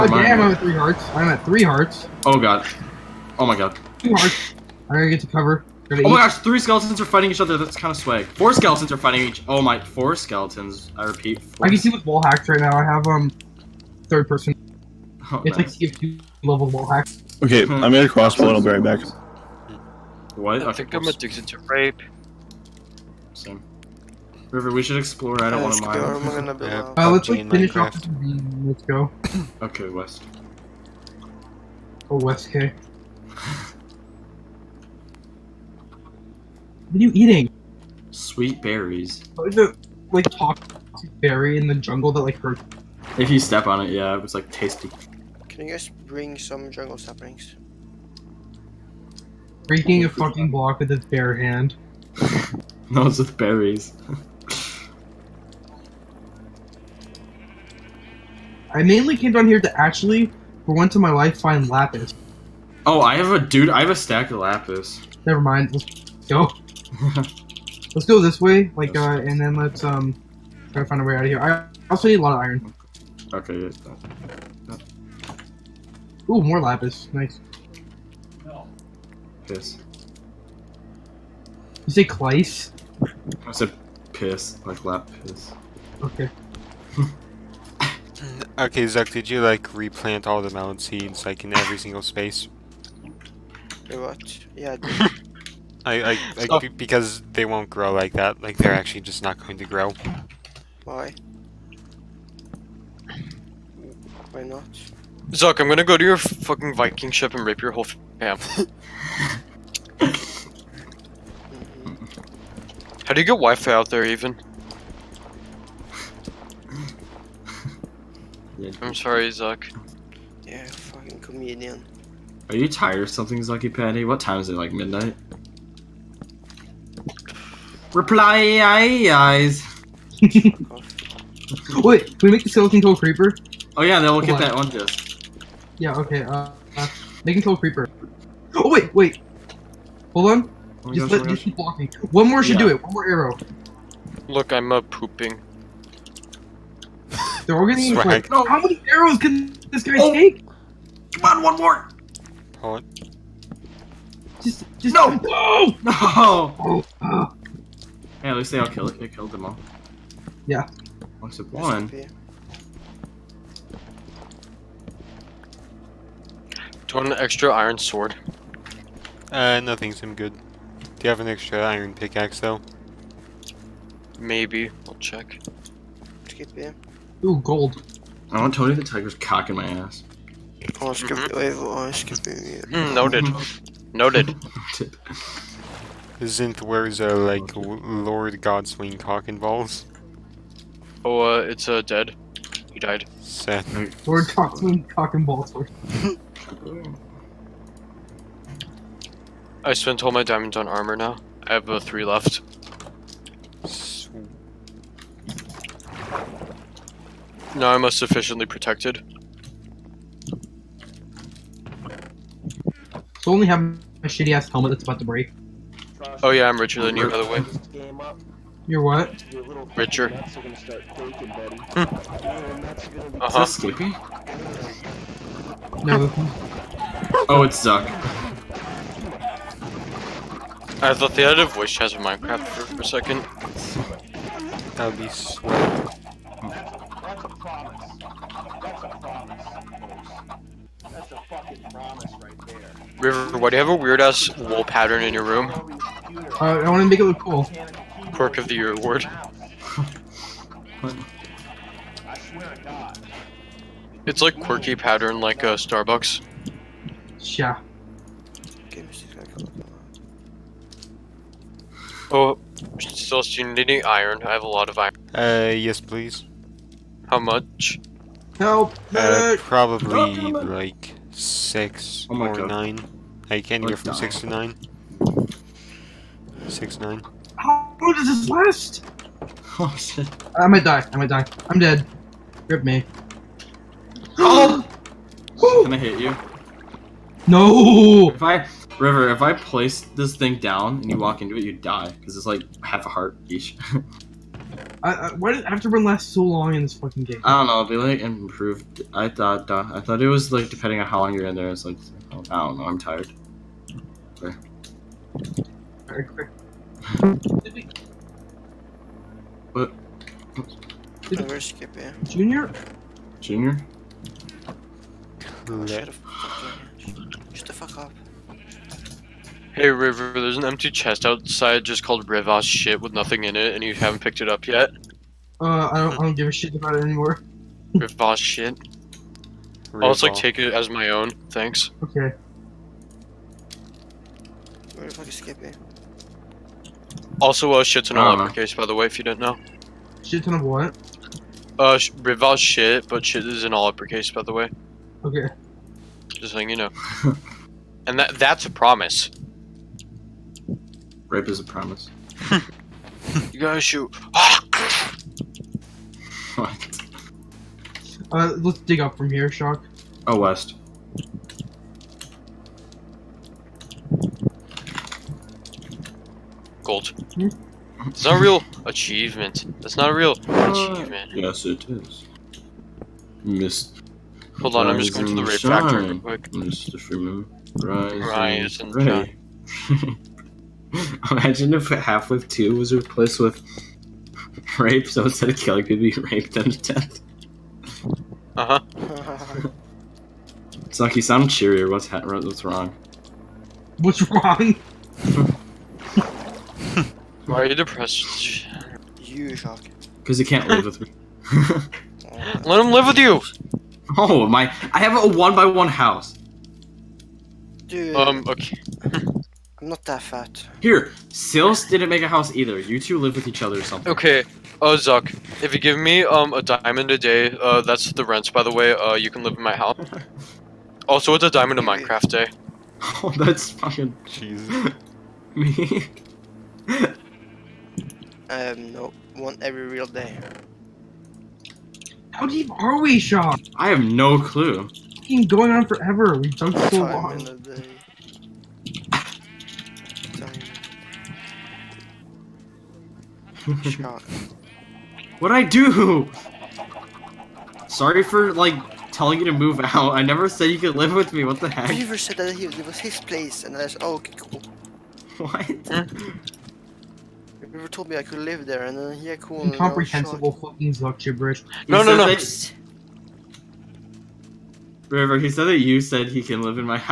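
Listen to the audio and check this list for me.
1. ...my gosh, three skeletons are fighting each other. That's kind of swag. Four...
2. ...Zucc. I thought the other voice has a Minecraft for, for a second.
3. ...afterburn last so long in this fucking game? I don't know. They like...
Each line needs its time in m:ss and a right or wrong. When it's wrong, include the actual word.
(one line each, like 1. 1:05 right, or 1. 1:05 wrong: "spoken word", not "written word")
1. 0:05 right
2. 3:47 right
3. 4:55 right.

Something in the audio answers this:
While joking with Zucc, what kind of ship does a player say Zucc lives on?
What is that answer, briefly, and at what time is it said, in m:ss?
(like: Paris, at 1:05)
Viking ship, at 1:46.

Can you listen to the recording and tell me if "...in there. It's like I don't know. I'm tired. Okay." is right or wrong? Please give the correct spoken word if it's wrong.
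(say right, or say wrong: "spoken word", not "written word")
right.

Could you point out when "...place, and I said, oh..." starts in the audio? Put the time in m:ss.
7:33.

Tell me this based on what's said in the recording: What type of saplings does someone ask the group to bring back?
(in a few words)
Jungle saplings.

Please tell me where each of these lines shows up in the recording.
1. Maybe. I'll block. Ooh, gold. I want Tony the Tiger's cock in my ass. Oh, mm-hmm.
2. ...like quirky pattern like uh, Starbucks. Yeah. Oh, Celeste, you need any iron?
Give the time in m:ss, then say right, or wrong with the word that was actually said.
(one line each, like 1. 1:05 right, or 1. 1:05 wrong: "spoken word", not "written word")
1. 2:54 wrong: "check", not "block"
2. 4:14 right.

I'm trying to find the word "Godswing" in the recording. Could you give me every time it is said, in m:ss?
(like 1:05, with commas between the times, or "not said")
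3:08, 3:14.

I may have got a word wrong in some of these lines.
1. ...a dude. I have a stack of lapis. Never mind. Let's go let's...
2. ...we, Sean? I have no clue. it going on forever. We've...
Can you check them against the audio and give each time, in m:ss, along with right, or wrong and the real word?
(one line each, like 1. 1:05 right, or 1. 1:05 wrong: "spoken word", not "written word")
1. 1:03 right
2. 7:12 right.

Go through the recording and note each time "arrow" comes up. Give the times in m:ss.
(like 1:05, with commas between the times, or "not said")
2:23, 2:28.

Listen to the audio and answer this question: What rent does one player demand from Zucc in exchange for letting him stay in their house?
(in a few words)
A diamond a day.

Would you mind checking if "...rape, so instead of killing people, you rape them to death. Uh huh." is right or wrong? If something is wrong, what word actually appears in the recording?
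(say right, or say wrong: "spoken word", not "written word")
right.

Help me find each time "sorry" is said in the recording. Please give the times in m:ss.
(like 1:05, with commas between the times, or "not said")
1:58, 7:27.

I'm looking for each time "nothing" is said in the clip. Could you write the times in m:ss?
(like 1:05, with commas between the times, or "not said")
2:49, 5:22.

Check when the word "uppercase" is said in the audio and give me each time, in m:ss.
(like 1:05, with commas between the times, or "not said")
5:38, 5:43.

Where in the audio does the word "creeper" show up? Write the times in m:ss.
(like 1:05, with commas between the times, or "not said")
2:12, 2:17.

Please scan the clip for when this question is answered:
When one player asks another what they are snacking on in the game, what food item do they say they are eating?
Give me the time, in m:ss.
0:38.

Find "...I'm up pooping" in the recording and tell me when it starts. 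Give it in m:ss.
2:24.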